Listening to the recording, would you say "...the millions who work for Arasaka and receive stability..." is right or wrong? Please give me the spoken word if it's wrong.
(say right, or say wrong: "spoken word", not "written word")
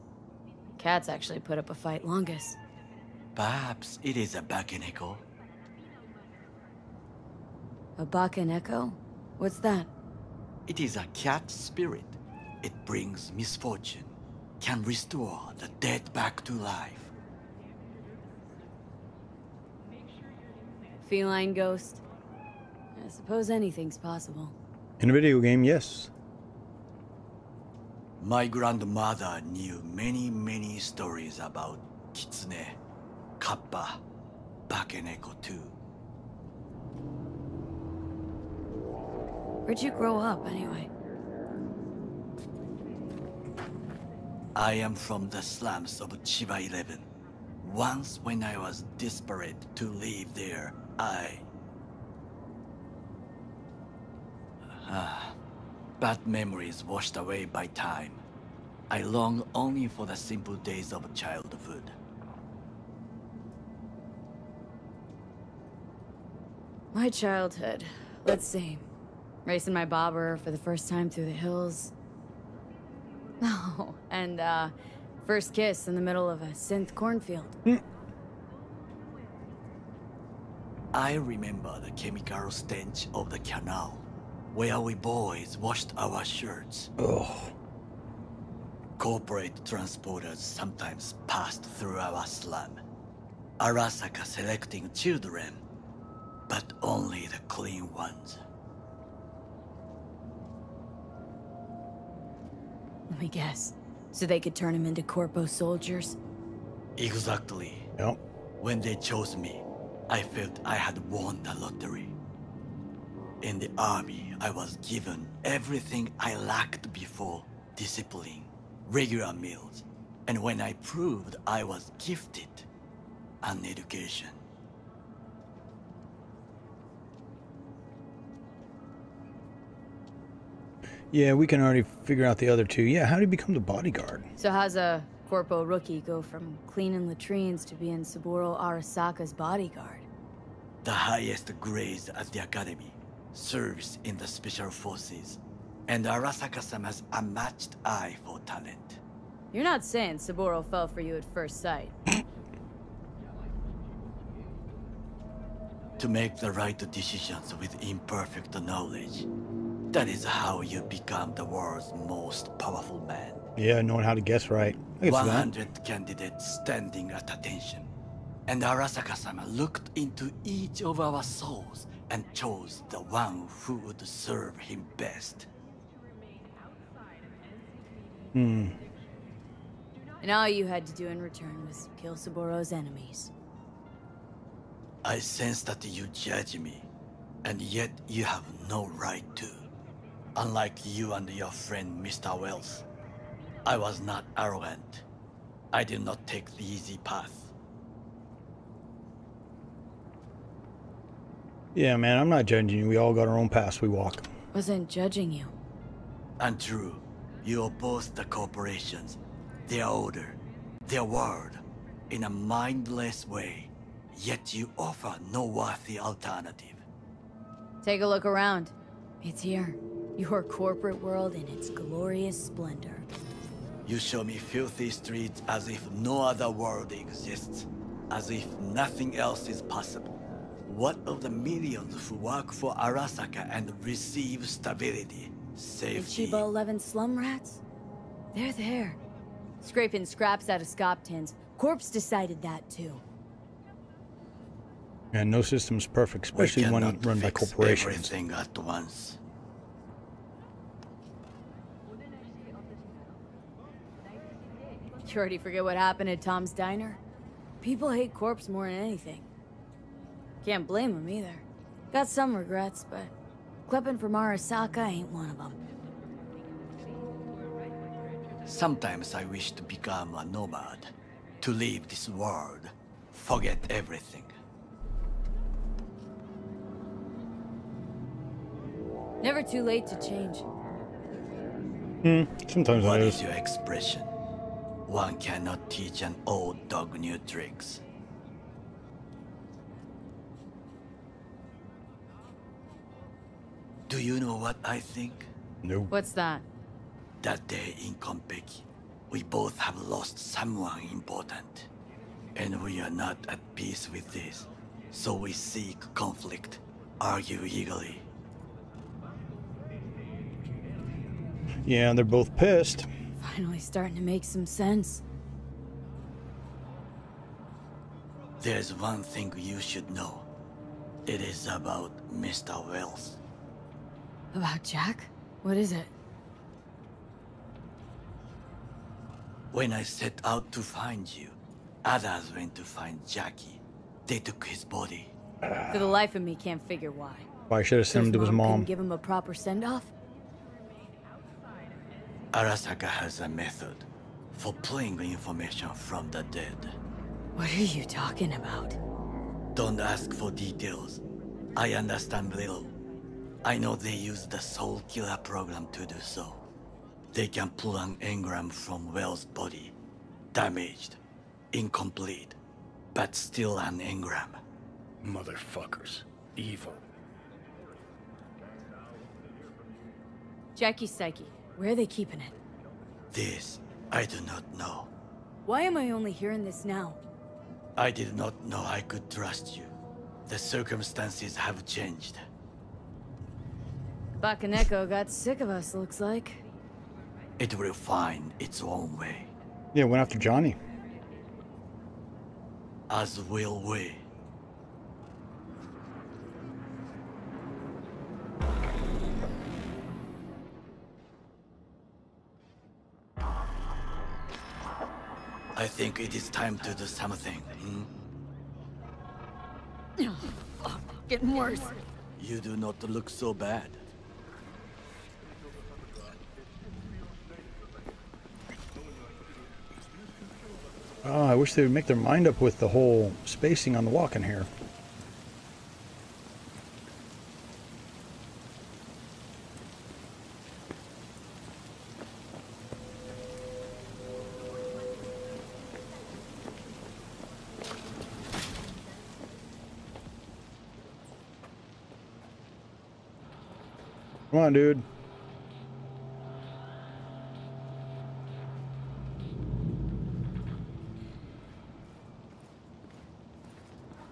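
right.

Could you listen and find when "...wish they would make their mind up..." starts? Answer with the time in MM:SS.
07:01.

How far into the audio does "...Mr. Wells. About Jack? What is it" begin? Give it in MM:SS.
05:22.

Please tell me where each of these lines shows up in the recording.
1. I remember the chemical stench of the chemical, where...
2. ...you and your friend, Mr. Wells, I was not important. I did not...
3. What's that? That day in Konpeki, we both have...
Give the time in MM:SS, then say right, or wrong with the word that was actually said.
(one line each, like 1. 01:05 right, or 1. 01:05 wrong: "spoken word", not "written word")
1. 01:20 wrong: "canal", not "chemical"
2. 03:10 wrong: "arrogant", not "important"
3. 04:55 right.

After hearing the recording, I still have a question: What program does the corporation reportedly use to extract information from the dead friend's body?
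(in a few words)
Soul Killer.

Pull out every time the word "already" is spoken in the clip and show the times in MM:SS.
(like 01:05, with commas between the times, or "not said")
02:11, 04:15.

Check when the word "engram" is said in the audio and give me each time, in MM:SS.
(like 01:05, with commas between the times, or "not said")
05:57, 06:03.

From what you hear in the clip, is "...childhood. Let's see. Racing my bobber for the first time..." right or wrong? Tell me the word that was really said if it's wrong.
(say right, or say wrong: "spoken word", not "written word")
right.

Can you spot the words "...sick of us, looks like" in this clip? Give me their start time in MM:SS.
06:25.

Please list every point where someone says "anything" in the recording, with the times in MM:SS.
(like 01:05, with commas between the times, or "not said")
00:23, 04:18.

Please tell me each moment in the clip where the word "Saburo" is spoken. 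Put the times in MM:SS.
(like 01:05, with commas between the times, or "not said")
02:18, 02:30, 03:02.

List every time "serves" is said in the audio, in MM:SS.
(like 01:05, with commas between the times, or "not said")
02:23, 02:54.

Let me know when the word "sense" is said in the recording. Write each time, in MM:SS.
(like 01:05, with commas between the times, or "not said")
03:05, 05:14.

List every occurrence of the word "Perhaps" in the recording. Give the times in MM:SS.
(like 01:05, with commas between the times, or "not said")
00:03.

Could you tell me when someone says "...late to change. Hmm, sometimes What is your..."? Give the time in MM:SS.
04:39.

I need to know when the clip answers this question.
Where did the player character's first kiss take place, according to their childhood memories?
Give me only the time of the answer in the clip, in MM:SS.
01:16.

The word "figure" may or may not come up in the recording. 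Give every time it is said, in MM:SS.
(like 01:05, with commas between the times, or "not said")
02:12, 05:36.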